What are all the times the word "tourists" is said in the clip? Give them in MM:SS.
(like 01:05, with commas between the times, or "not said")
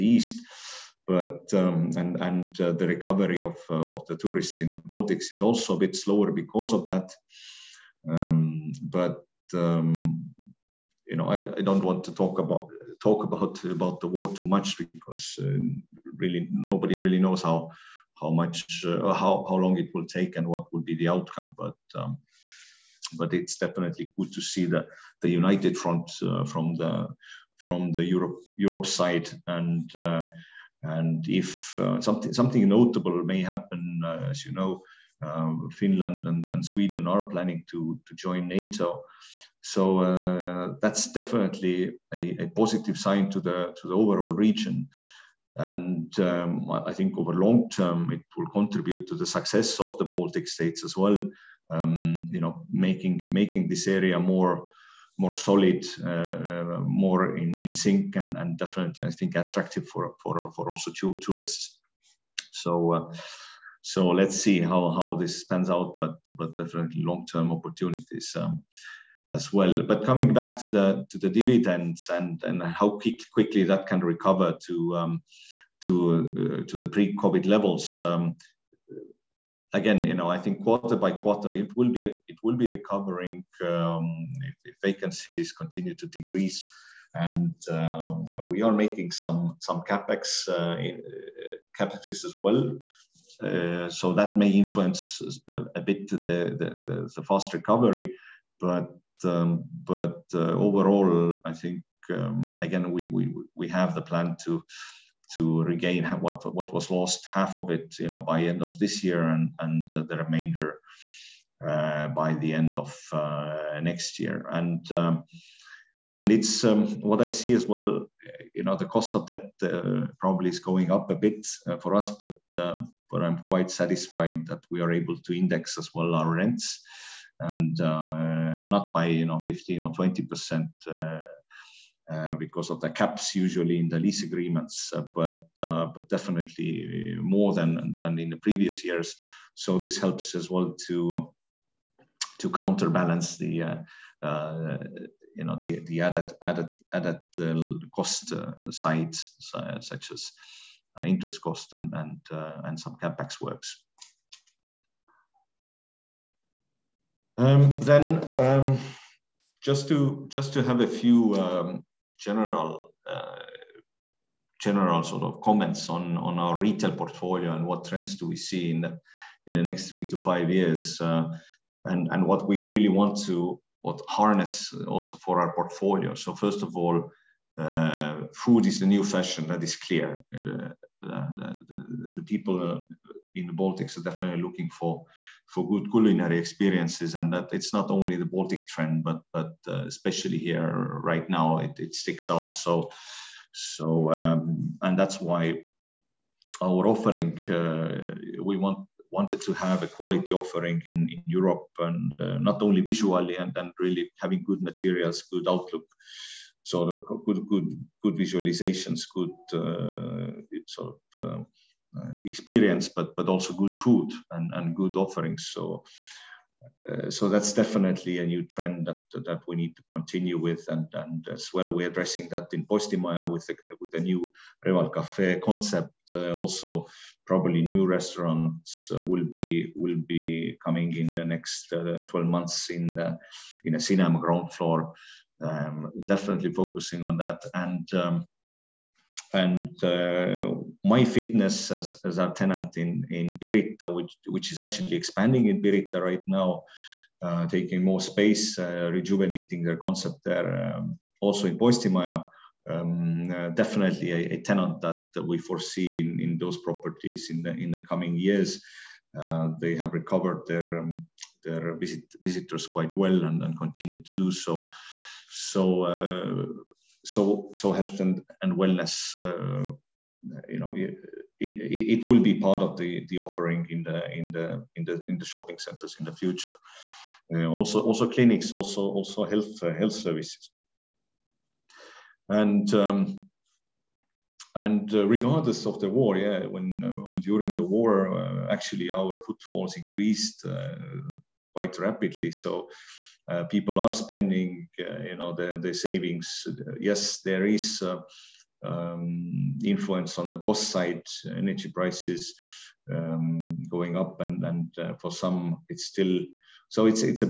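00:04, 01:01.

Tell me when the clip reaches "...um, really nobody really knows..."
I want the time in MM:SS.
00:15.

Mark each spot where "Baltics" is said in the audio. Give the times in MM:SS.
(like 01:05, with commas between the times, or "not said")
00:04, 00:50, 03:03, 03:08.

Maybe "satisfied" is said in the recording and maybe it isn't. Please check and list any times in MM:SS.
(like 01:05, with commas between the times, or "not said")
02:03.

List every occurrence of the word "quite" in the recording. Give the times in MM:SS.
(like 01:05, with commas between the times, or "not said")
02:03, 04:22, 04:51.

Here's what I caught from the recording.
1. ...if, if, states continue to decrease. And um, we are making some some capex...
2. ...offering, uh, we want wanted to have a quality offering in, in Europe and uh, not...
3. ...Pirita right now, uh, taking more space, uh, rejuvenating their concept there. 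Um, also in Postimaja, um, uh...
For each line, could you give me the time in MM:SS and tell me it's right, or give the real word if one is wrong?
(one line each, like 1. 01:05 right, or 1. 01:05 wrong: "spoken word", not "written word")
1. 01:24 wrong: "vacancies", not "states"
2. 03:16 right
3. 04:05 right.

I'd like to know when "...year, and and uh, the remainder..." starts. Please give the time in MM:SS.
01:49.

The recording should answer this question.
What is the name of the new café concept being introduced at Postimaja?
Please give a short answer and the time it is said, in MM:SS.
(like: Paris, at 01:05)
Reval Cafe, at 03:44.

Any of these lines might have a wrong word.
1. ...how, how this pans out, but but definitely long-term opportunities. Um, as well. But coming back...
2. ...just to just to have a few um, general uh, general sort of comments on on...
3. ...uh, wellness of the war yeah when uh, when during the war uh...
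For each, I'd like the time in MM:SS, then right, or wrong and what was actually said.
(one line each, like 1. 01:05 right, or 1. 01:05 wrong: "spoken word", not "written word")
1. 01:04 right
2. 02:39 right
3. 04:44 wrong: "regardless", not "wellness".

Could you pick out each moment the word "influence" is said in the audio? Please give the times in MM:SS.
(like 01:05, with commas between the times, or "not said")
01:34, 04:59.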